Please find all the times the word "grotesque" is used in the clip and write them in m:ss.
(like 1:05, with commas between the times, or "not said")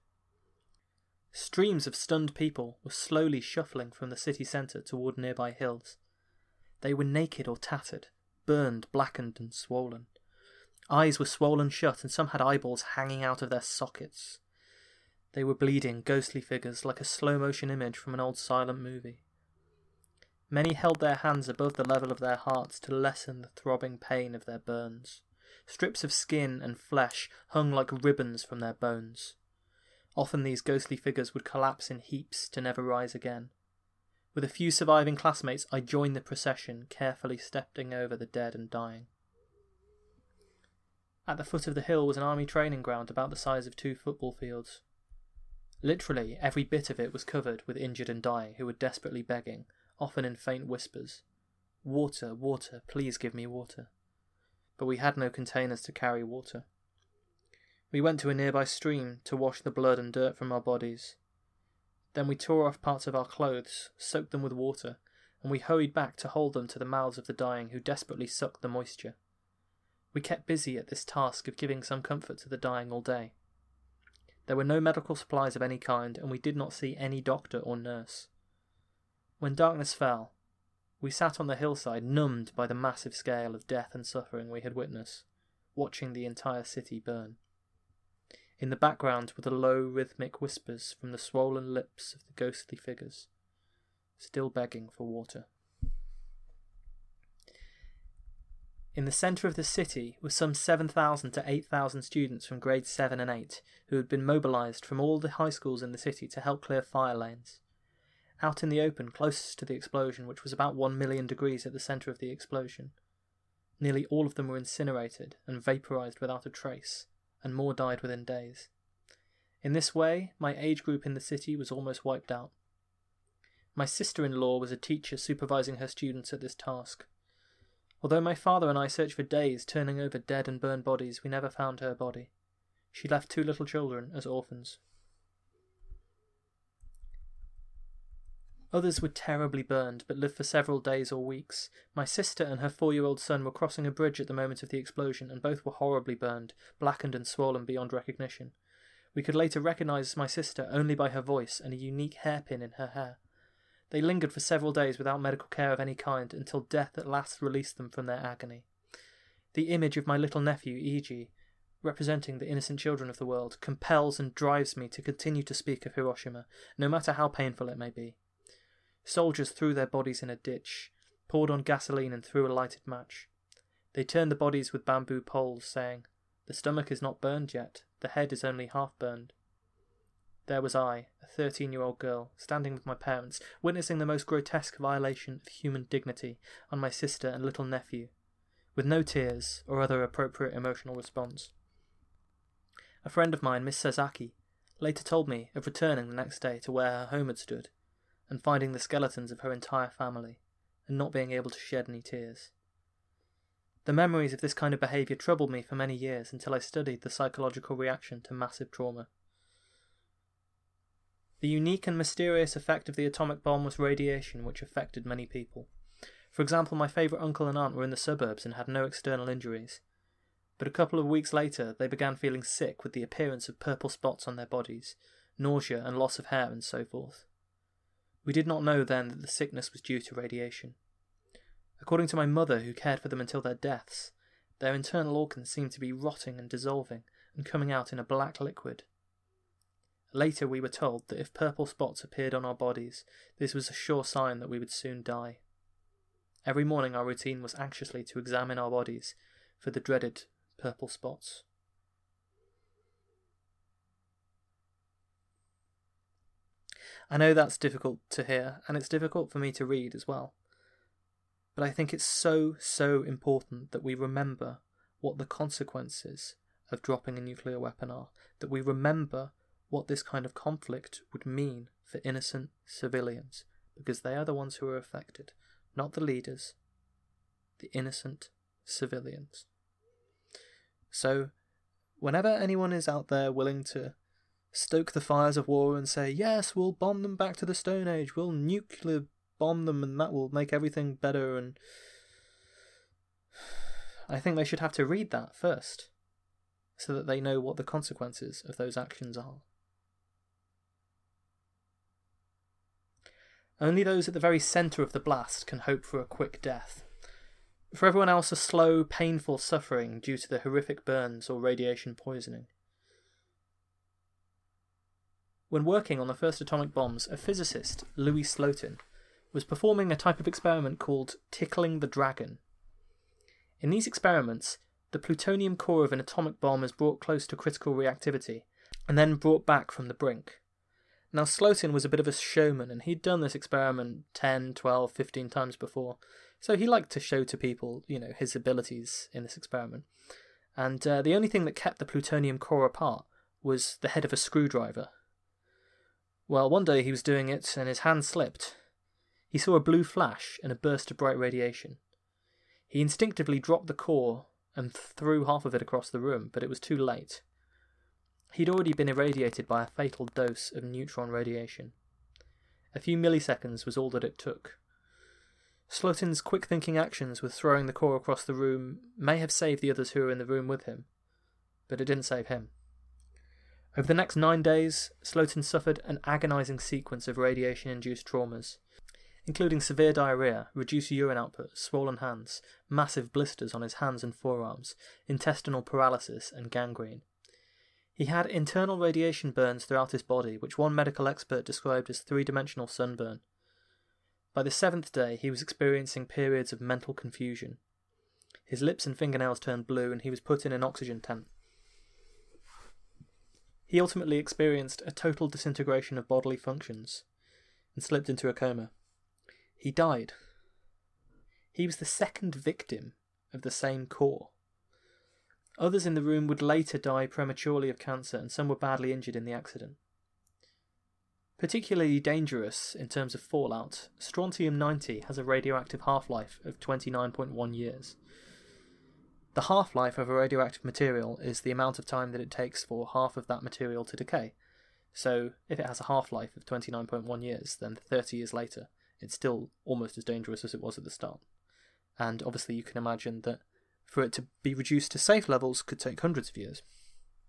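3:04.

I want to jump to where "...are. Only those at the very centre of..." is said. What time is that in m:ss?
4:59.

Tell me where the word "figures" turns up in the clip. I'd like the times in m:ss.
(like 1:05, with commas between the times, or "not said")
0:16, 0:30, 1:32.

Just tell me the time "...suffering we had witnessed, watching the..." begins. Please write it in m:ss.
1:24.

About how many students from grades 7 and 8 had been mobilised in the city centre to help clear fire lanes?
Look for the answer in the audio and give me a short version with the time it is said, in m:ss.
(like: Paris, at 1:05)
7,000 to 8,000, at 1:40.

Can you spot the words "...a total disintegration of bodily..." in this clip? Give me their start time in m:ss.
6:44.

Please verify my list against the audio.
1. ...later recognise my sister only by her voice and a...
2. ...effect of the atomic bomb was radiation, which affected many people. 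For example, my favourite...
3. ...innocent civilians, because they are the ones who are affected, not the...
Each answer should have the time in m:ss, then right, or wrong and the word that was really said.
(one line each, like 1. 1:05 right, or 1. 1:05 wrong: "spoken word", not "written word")
1. 2:29 right
2. 3:32 right
3. 4:32 right.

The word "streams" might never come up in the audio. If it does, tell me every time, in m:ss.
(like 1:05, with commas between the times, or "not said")
0:01, 0:58.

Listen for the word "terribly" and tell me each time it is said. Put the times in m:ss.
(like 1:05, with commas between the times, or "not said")
2:19.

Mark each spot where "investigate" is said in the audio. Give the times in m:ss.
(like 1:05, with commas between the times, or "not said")
not said.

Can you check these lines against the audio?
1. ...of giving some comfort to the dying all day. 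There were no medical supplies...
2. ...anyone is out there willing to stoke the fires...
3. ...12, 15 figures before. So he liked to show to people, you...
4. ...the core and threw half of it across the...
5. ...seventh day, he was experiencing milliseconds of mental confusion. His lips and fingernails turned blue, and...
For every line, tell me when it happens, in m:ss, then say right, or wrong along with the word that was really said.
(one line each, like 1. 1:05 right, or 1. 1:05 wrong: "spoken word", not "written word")
1. 1:11 right
2. 4:42 right
3. 5:34 wrong: "times", not "figures"
4. 5:53 right
5. 6:34 wrong: "periods", not "milliseconds".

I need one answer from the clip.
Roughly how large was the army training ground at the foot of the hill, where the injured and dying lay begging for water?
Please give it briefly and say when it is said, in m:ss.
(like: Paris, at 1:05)
two football fields, at 0:43.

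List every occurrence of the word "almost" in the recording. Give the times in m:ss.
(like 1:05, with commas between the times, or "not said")
2:01, 7:19.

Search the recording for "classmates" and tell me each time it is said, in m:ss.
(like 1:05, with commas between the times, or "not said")
0:35.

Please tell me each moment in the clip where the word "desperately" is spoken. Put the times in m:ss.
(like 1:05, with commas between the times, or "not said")
0:48, 1:07.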